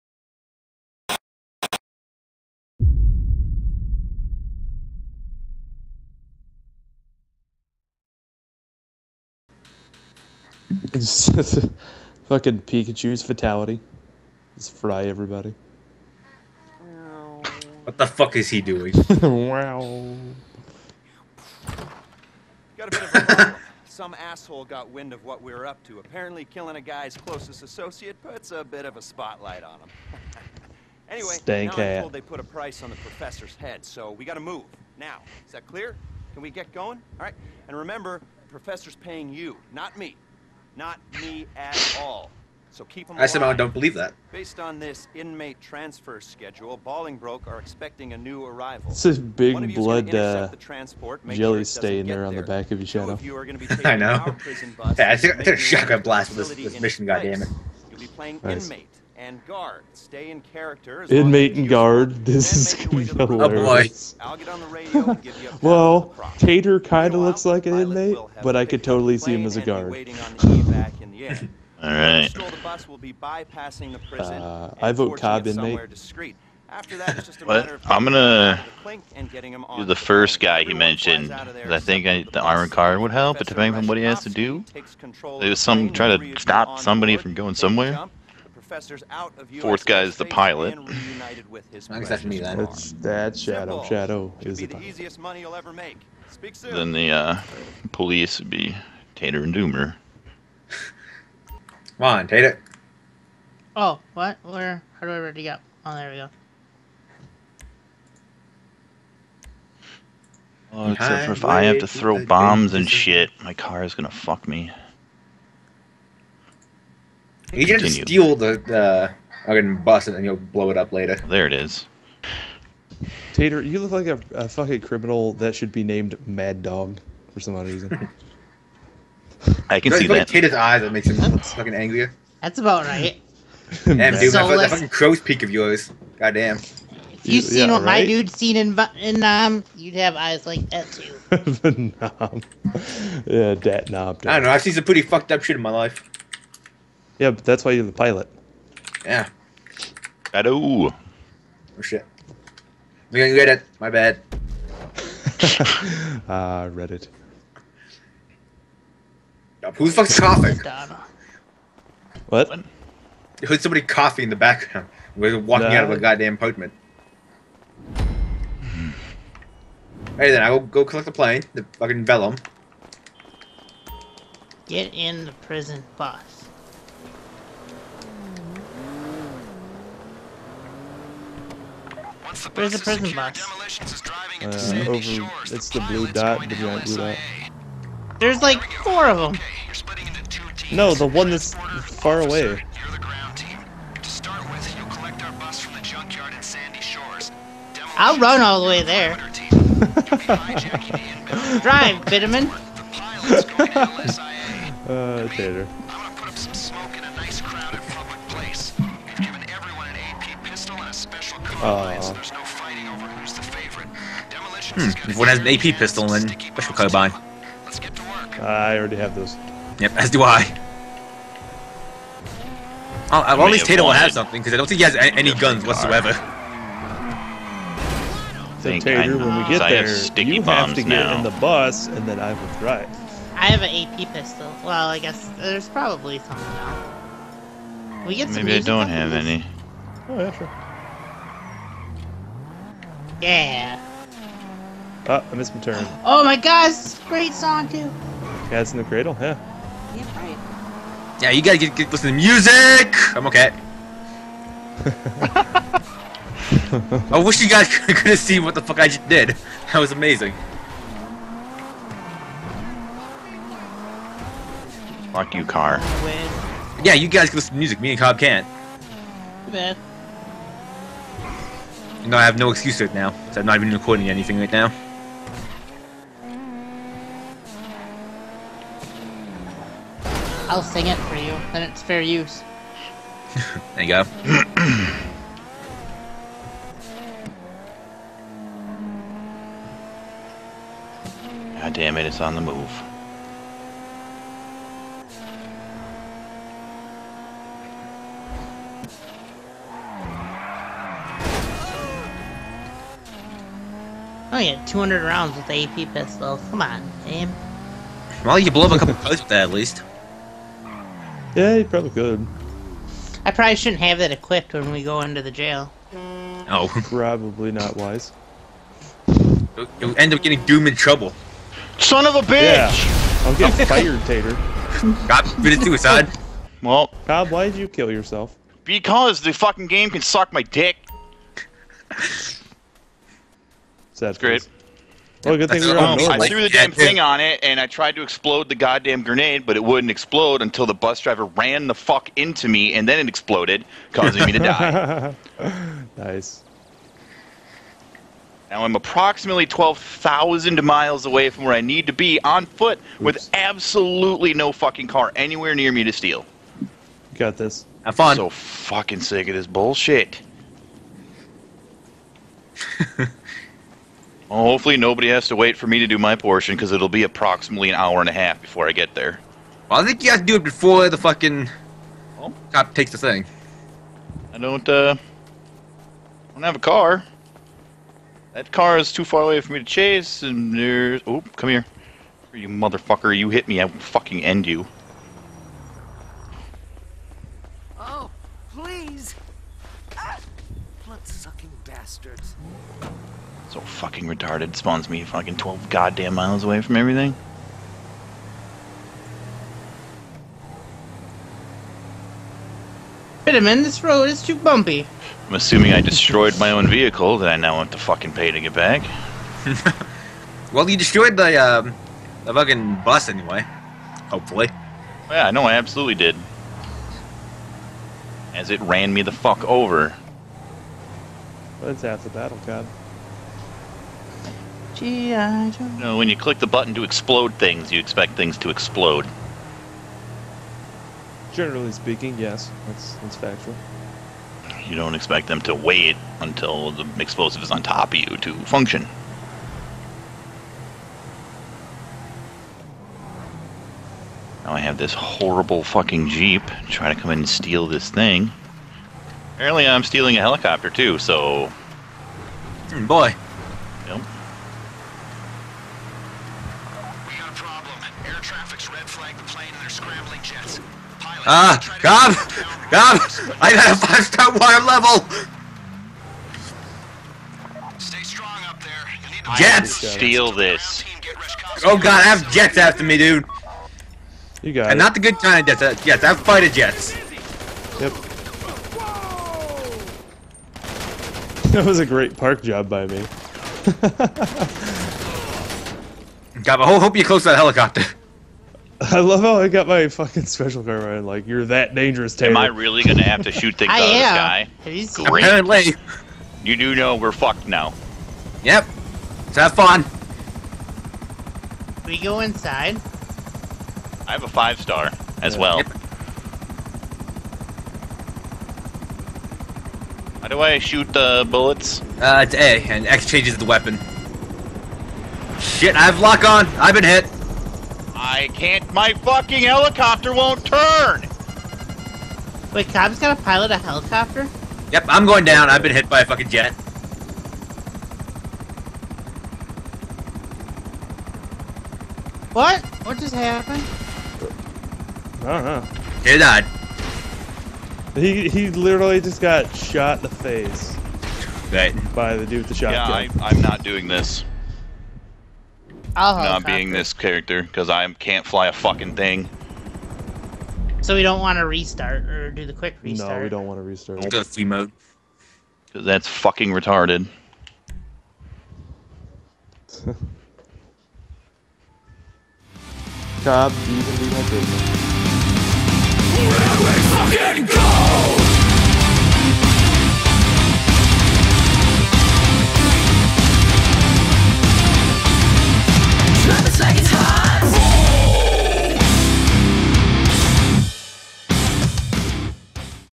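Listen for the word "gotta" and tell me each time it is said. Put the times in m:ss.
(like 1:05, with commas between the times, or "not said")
0:34, 4:11.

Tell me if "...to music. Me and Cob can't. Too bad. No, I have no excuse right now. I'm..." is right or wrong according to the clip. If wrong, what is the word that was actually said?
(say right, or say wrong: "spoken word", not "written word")
right.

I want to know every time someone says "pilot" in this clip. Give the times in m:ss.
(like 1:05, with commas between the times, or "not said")
1:30, 1:34, 2:27, 7:40, 8:43.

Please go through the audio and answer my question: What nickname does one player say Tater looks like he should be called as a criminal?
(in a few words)
Mad Dog.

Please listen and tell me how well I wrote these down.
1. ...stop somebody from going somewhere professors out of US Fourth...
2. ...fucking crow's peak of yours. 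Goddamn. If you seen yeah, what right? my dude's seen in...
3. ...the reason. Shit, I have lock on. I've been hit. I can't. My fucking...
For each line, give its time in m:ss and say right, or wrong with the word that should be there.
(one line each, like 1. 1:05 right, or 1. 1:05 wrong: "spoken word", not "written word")
1. 1:26 right
2. 2:14 right
3. 8:33 wrong: "weapon", not "reason".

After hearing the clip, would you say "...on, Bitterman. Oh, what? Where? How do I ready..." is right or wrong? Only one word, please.
wrong.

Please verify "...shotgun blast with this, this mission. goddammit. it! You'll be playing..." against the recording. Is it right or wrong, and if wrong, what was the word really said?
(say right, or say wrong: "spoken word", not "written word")
right.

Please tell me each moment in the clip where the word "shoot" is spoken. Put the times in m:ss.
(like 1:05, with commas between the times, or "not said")
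8:13, 8:30.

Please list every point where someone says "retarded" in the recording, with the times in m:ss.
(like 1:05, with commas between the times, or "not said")
6:34, 9:16.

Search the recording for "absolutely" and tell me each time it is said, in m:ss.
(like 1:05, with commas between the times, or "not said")
5:53, 6:55.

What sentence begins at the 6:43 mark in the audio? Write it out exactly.
Wait a minute, this road is too bumpy.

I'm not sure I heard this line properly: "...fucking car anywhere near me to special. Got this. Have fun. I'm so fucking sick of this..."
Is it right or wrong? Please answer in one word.
wrong.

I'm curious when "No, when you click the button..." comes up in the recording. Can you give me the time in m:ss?
7:05.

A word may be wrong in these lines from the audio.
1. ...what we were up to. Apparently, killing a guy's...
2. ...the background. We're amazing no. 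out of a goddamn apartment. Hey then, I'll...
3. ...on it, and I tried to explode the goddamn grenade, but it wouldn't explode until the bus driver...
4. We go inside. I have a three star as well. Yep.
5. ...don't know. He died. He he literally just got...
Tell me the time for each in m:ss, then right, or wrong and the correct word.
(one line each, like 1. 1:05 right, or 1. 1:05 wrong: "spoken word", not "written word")
1. 0:25 right
2. 2:44 wrong: "walking", not "amazing"
3. 5:36 right
4. 8:21 wrong: "five", not "three"
5. 8:55 right.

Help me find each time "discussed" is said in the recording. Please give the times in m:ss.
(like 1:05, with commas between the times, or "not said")
not said.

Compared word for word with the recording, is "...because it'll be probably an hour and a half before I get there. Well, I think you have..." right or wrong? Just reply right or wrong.
wrong.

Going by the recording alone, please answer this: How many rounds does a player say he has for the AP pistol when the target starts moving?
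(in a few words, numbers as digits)
200.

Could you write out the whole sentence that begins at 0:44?
Based on this inmate transfer schedule, Bolingbroke are expecting a new arrival.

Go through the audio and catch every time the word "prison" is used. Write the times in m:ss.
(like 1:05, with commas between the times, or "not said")
2:55, 3:02.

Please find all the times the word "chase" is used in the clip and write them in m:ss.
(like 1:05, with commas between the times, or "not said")
6:19.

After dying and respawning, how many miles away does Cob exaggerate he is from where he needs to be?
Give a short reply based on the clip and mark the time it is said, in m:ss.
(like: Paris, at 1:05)
12,000, at 5:49.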